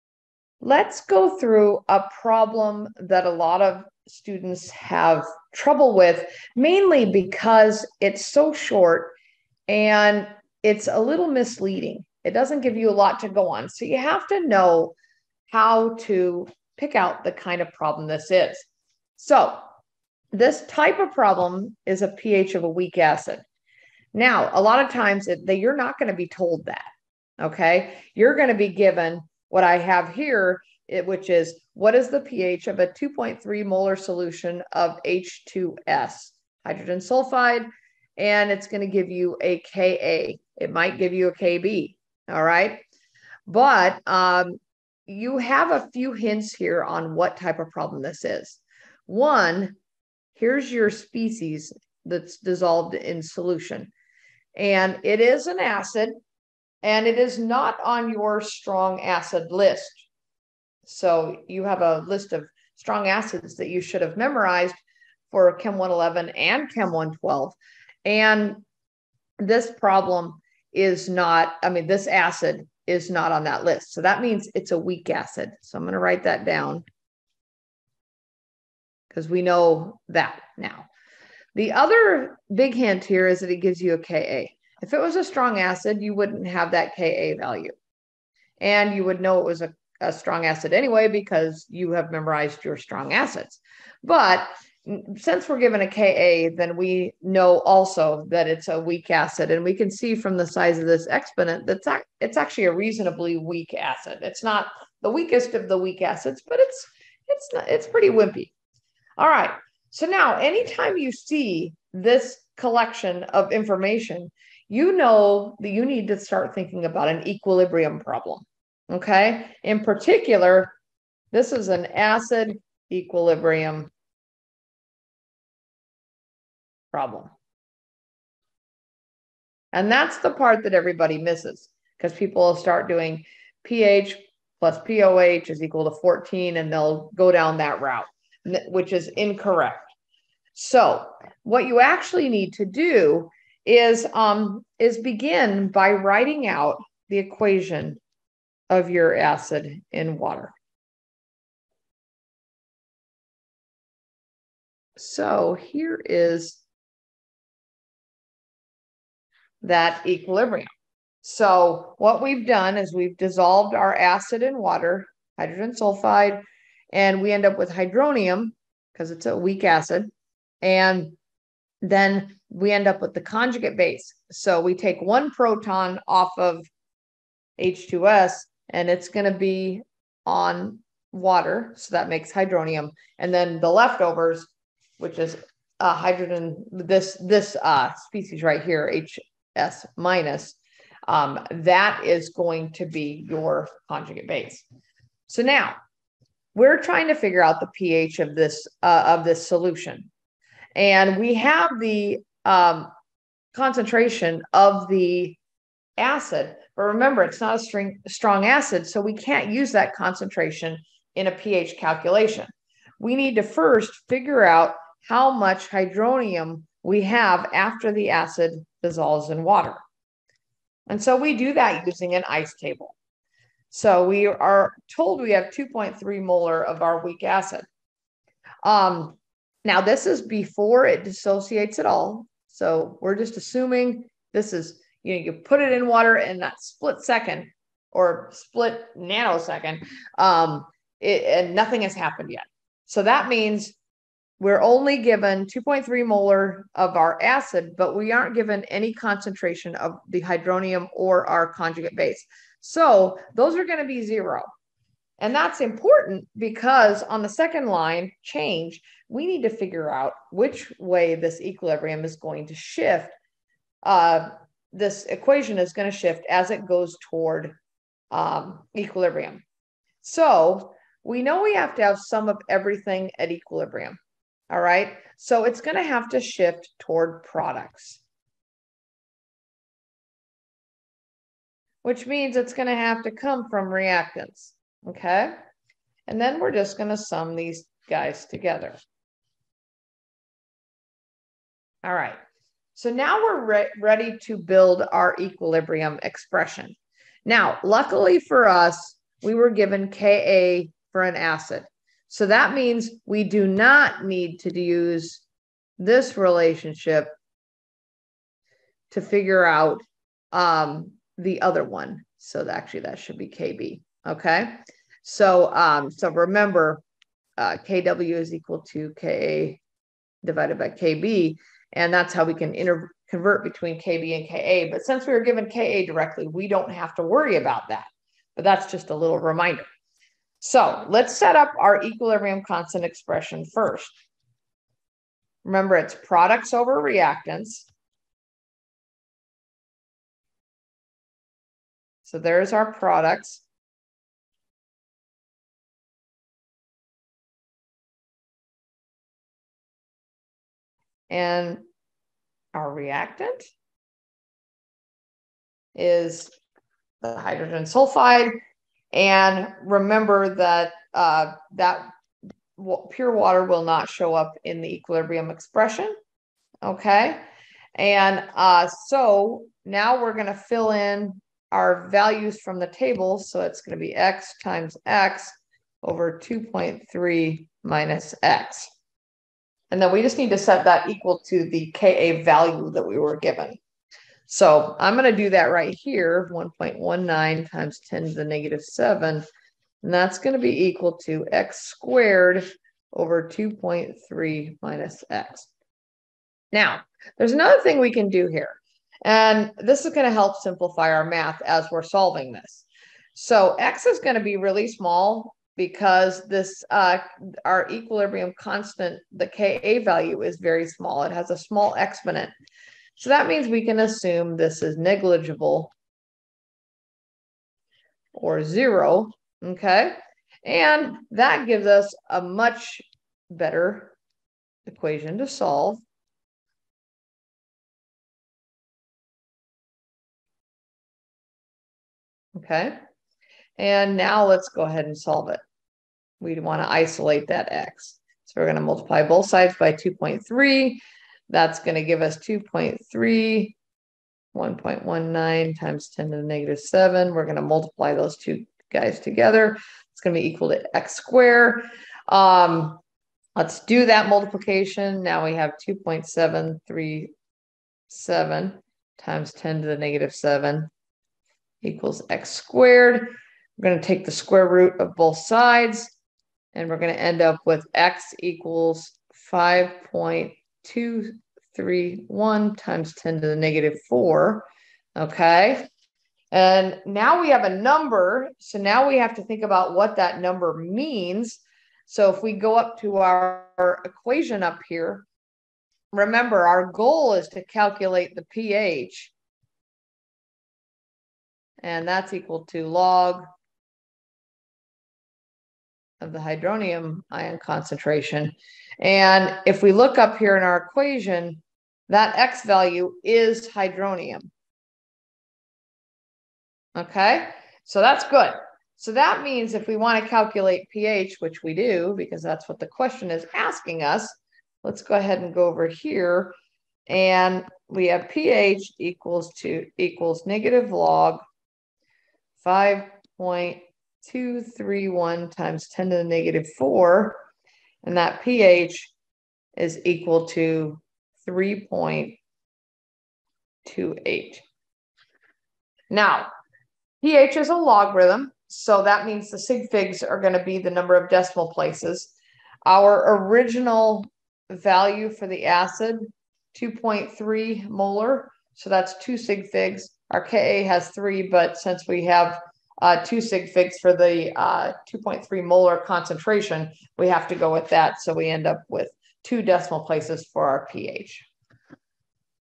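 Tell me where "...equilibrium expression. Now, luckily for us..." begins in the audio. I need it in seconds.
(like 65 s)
295 s.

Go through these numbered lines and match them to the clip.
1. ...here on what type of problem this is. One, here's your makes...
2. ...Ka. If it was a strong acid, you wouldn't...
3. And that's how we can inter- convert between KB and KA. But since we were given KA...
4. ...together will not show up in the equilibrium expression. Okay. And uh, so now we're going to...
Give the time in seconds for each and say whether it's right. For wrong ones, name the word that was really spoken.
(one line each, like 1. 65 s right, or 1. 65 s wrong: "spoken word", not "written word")
1. 46 s wrong: "species", not "makes"
2. 83 s right
3. 321 s right
4. 363 s wrong: "water", not "together".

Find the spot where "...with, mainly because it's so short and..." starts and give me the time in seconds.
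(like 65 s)
5 s.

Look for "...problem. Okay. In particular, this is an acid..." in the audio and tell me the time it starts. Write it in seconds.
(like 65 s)
117 s.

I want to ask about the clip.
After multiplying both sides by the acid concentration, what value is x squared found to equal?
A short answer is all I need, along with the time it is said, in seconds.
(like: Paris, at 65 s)
2.737 × 10^-7, at 455 s.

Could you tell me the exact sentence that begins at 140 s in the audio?
So, what you actually need to do is um, is begin by writing out the equation of your acid in water.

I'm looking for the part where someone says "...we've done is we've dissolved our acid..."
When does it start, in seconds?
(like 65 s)
162 s.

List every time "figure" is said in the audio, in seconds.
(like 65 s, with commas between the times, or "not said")
197 s, 214 s, 259 s, 309 s.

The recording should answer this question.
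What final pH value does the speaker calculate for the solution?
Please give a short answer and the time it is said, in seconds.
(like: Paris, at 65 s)
3.28, at 531 s.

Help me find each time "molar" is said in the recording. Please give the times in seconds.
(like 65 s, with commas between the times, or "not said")
33 s, 226 s, 246 s, 547 s, 555 s.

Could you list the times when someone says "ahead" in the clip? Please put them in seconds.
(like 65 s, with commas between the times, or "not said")
434 s, 514 s.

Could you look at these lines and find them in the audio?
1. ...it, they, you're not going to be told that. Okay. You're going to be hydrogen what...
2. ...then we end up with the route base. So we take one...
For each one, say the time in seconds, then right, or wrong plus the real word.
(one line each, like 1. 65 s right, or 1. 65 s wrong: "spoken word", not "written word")
1. 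25 s wrong: "given", not "hydrogen"
2. 171 s wrong: "conjugate", not "route".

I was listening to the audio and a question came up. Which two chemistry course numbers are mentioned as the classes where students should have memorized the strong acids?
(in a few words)
Chem 111 and Chem 112.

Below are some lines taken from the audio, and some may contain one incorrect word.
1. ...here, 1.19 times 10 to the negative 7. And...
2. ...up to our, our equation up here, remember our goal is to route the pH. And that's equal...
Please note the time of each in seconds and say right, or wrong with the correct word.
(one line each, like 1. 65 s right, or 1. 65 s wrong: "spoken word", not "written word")
1. 385 s right
2. 482 s wrong: "calculate", not "route".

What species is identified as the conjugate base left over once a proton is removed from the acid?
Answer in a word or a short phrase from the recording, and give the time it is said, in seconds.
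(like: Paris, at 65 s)
HS minus, at 189 s.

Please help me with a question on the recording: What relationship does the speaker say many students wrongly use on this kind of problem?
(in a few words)
pH plus pOH equals 14.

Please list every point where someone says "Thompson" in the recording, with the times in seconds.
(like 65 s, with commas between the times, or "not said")
not said.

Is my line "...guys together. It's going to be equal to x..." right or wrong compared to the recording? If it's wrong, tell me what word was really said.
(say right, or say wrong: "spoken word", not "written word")
right.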